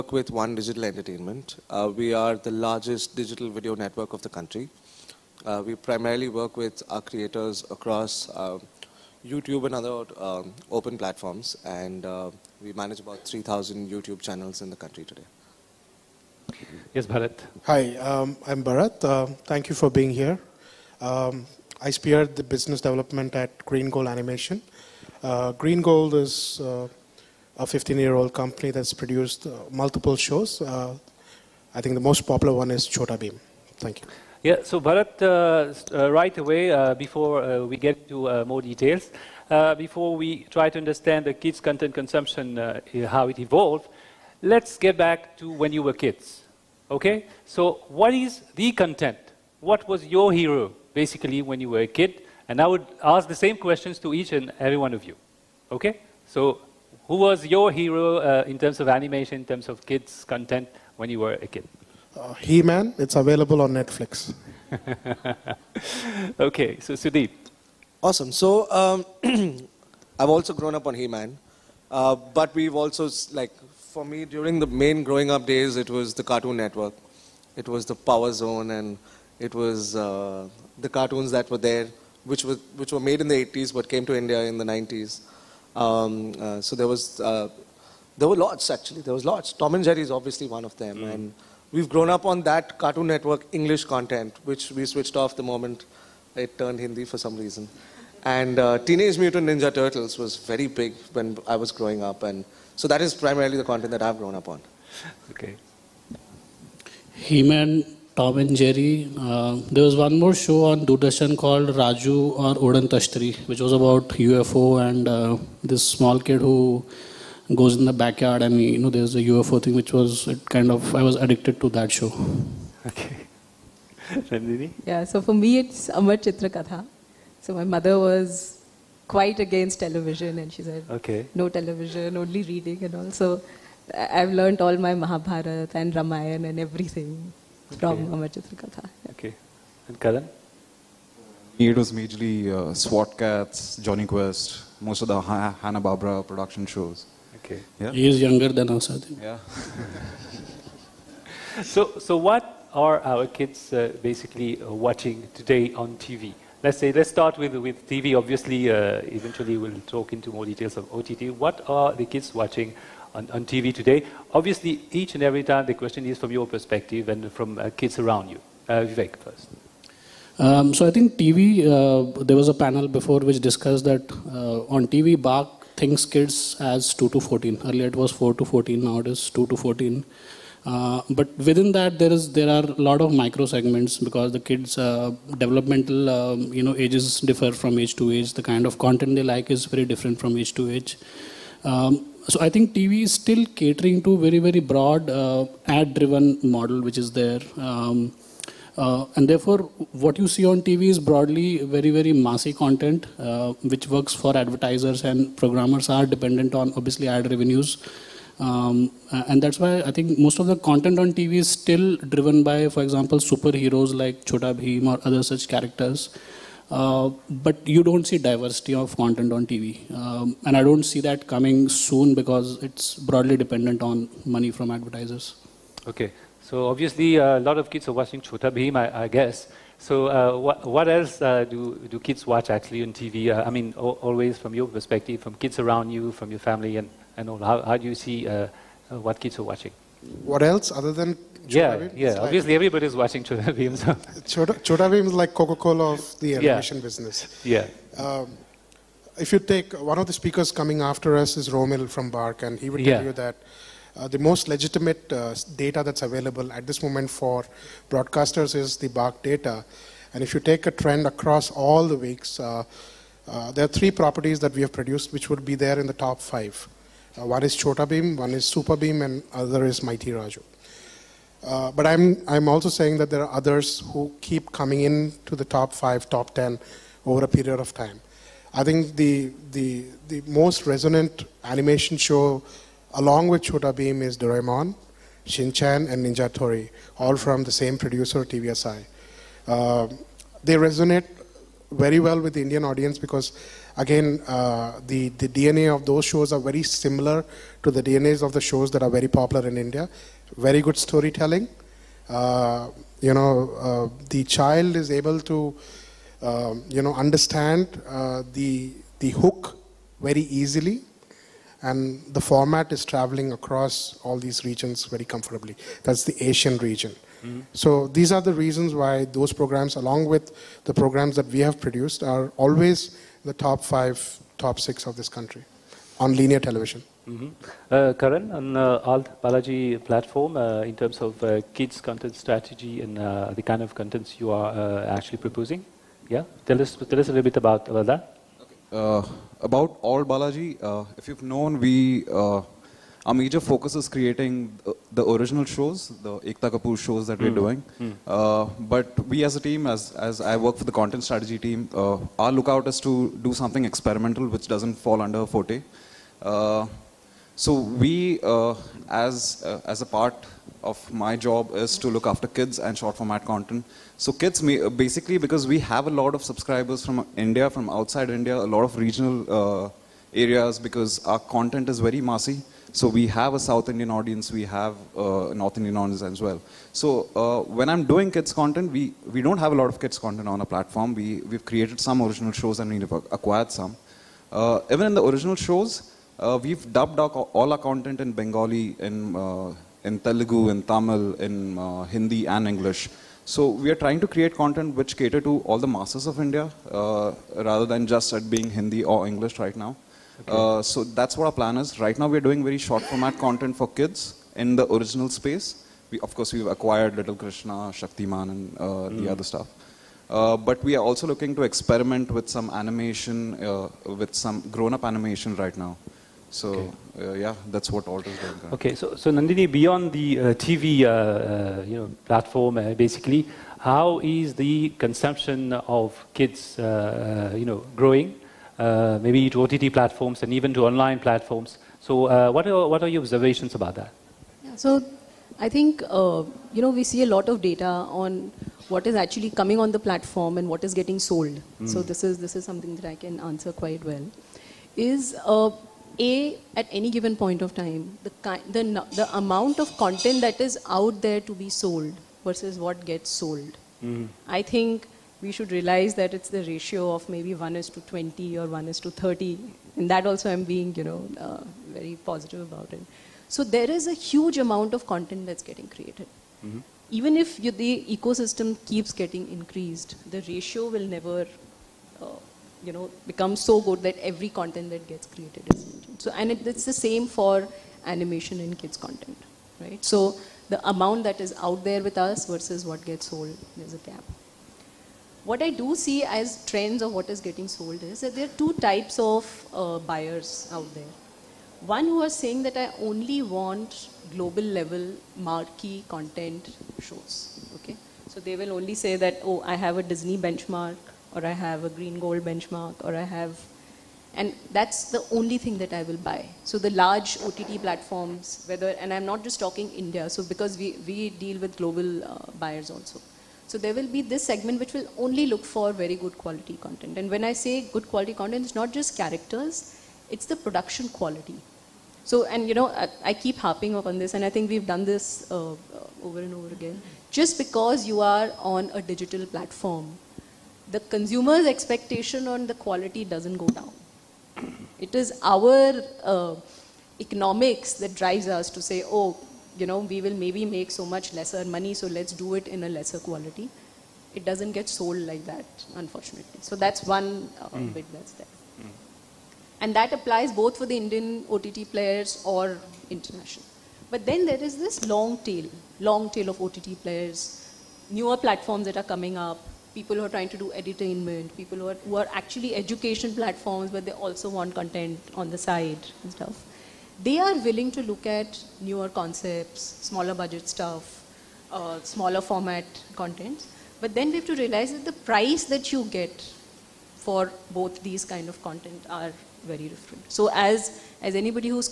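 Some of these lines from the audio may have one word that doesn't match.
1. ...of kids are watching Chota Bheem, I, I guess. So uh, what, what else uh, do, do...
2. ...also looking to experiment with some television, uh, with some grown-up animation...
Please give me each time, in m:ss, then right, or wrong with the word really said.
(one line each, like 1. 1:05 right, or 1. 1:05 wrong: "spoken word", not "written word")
1. 3:47 right
2. 6:50 wrong: "animation", not "television".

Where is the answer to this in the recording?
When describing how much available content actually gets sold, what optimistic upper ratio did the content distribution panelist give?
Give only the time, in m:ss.
7:38.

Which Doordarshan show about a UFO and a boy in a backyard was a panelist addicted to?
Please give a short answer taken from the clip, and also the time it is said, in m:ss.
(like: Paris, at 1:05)
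Raju or Odan Tashtri, at 1:51.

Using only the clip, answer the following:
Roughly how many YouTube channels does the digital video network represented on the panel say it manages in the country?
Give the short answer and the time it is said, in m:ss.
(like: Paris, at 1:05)
3,000, at 0:13.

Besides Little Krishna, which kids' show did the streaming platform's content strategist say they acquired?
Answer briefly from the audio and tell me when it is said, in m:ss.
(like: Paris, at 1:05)
Shaktiman, at 6:47.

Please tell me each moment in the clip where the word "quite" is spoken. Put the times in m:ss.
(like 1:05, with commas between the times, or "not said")
2:09, 7:23.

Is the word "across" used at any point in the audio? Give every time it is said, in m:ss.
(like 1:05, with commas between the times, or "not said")
0:07, 4:21, 5:13.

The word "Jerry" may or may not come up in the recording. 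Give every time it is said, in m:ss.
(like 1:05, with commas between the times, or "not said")
1:29, 1:48.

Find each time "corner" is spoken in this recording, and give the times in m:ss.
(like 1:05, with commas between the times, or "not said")
not said.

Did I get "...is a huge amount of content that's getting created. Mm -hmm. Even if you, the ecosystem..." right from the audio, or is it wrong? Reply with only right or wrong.
right.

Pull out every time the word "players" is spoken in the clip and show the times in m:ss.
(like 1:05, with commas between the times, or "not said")
9:11, 9:16.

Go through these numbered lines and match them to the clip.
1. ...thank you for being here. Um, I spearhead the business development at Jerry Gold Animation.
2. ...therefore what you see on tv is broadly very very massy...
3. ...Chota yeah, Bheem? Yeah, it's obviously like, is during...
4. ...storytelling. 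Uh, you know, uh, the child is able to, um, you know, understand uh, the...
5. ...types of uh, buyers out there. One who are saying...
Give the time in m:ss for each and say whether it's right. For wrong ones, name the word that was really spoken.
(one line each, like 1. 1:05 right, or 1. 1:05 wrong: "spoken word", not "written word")
1. 0:19 wrong: "Green", not "Jerry"
2. 3:19 right
3. 4:01 wrong: "watching", not "during"
4. 5:00 right
5. 8:08 right.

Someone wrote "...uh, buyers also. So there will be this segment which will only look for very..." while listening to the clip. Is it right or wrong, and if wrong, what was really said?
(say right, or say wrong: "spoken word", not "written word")
right.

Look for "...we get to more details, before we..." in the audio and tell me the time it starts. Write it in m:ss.
0:37.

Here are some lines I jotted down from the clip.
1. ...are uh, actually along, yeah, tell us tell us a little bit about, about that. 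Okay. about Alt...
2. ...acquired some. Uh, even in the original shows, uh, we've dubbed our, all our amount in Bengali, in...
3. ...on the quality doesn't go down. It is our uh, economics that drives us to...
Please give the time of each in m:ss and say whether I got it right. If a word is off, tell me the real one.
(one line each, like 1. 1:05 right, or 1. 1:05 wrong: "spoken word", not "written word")
1. 5:34 wrong: "proposing", not "along"
2. 6:22 wrong: "content", not "amount"
3. 8:52 right.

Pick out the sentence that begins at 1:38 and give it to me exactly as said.
And uh, Teenage Mutant Ninja Turtles was very big when I was growing up.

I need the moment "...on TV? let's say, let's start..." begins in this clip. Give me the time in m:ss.
2:35.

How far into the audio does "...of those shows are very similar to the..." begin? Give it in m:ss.
4:55.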